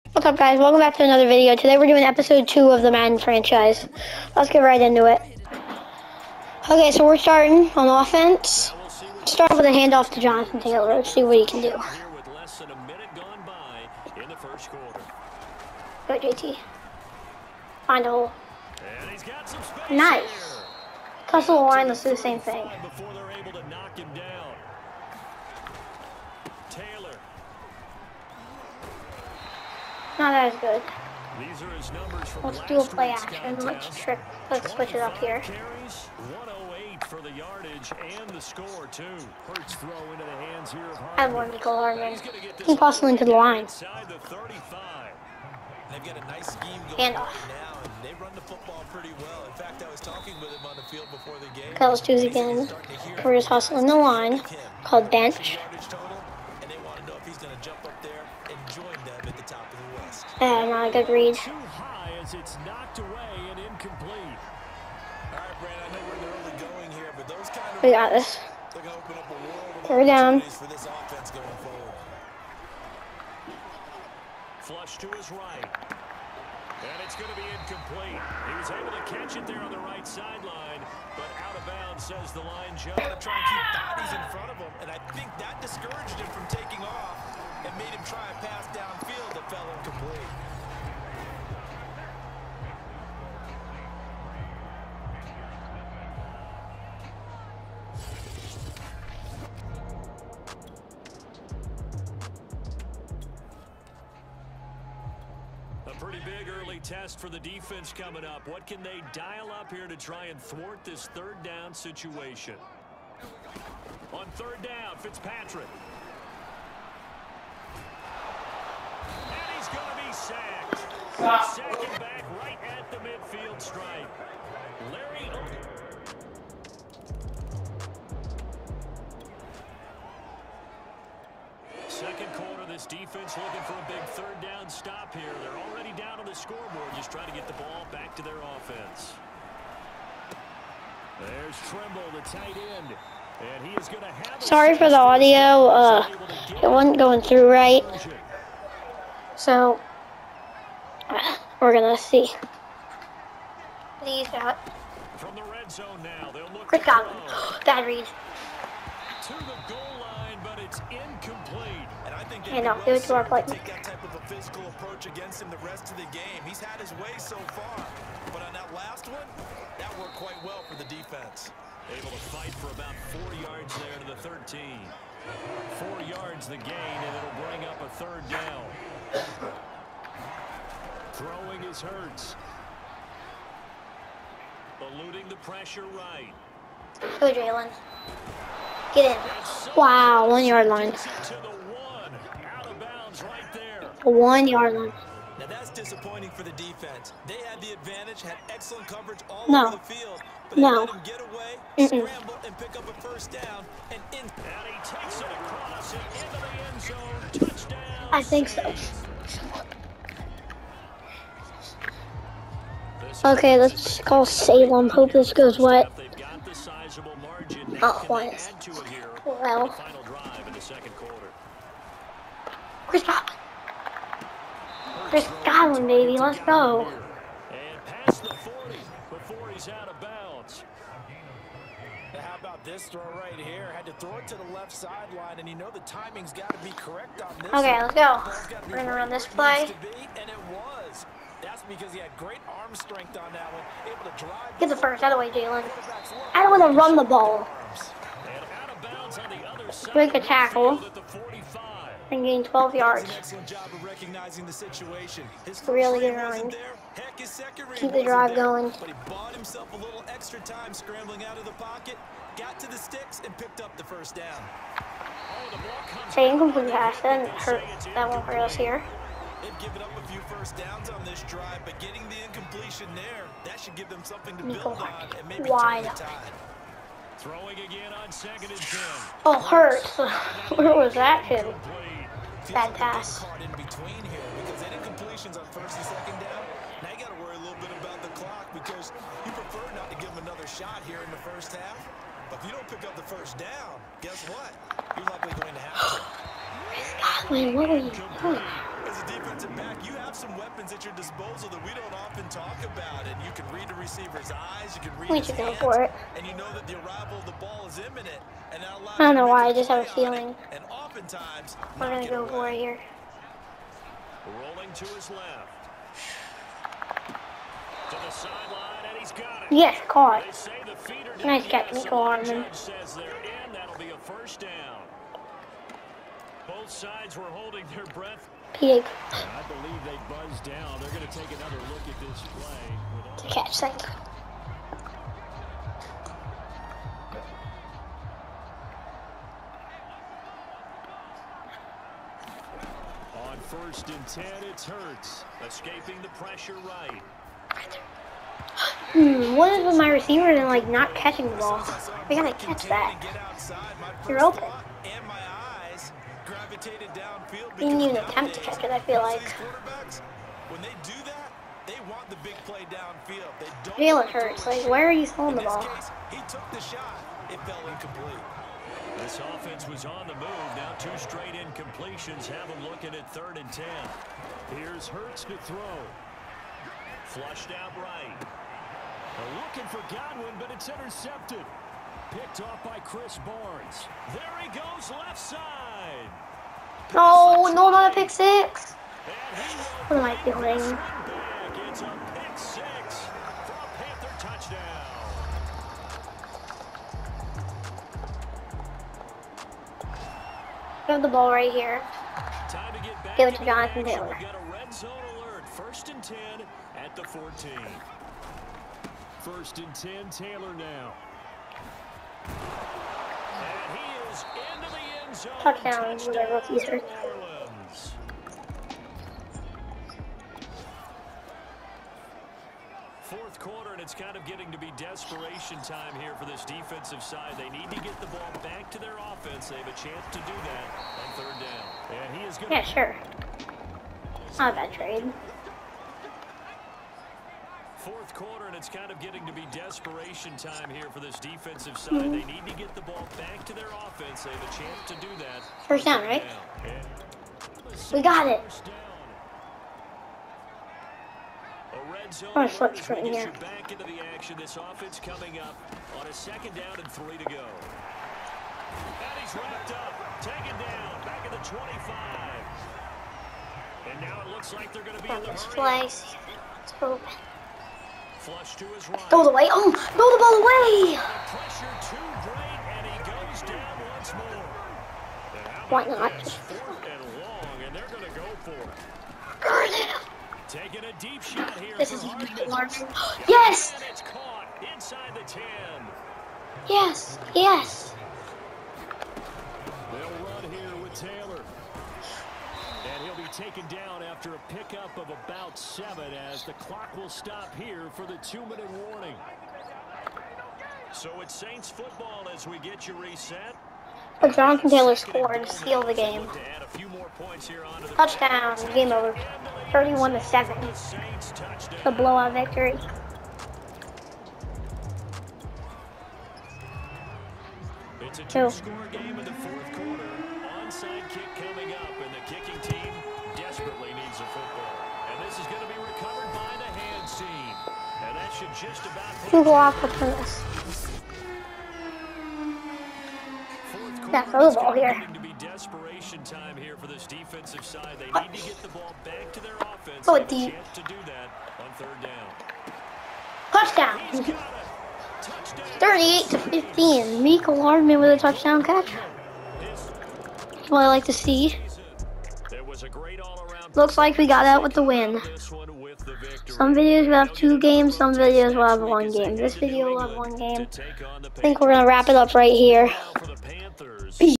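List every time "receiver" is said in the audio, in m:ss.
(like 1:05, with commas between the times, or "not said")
5:03, 5:49.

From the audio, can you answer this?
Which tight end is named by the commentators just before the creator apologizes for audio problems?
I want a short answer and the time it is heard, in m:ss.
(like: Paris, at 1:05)
Trimble, at 2:21.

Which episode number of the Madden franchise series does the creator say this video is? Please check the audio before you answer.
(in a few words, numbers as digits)
2.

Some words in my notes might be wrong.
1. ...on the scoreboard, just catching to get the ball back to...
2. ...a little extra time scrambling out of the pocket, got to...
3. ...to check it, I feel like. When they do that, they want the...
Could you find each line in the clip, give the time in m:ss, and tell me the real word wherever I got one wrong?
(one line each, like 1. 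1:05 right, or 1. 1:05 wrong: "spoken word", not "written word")
1. 2:16 wrong: "trying", not "catching"
2. 4:19 right
3. 5:58 right.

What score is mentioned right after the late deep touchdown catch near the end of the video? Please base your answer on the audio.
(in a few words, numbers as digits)
38 to 15.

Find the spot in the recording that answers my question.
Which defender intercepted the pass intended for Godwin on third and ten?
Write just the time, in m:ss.
6:22.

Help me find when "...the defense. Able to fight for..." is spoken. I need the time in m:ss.
2:50.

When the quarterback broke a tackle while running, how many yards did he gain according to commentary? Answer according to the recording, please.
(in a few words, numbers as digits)
12.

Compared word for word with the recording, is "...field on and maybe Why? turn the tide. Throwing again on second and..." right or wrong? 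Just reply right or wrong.
wrong.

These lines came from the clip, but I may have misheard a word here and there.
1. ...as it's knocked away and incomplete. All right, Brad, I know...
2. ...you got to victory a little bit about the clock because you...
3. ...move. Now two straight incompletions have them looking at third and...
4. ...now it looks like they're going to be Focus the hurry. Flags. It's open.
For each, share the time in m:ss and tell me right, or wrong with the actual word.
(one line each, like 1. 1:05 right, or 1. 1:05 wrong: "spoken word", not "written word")
1. 1:02 right
2. 4:46 wrong: "worry", not "victory"
3. 6:10 right
4. 7:44 right.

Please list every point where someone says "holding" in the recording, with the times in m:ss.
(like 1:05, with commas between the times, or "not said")
5:27.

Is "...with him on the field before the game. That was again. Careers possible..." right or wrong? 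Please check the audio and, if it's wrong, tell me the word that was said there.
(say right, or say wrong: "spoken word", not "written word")
wrong: "hustle", not "possible".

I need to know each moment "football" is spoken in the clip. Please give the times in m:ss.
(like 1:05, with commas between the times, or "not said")
0:48, 8:21.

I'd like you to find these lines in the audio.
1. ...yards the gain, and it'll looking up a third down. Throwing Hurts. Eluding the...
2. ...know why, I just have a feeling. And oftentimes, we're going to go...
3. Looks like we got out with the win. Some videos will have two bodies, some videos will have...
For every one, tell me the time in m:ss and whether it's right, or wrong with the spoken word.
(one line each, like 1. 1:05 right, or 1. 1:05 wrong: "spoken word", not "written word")
1. 2:56 wrong: "bring", not "looking"
2. 5:09 right
3. 9:13 wrong: "games", not "bodies".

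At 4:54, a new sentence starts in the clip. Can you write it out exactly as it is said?
You're likely going to have to.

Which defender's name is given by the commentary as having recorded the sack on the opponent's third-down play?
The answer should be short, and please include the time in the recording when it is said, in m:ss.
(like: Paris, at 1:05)
Fitzpatrick, at 1:54.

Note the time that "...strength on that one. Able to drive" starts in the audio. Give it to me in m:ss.
4:02.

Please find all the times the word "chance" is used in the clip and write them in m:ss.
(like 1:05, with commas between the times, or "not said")
7:09, 7:24.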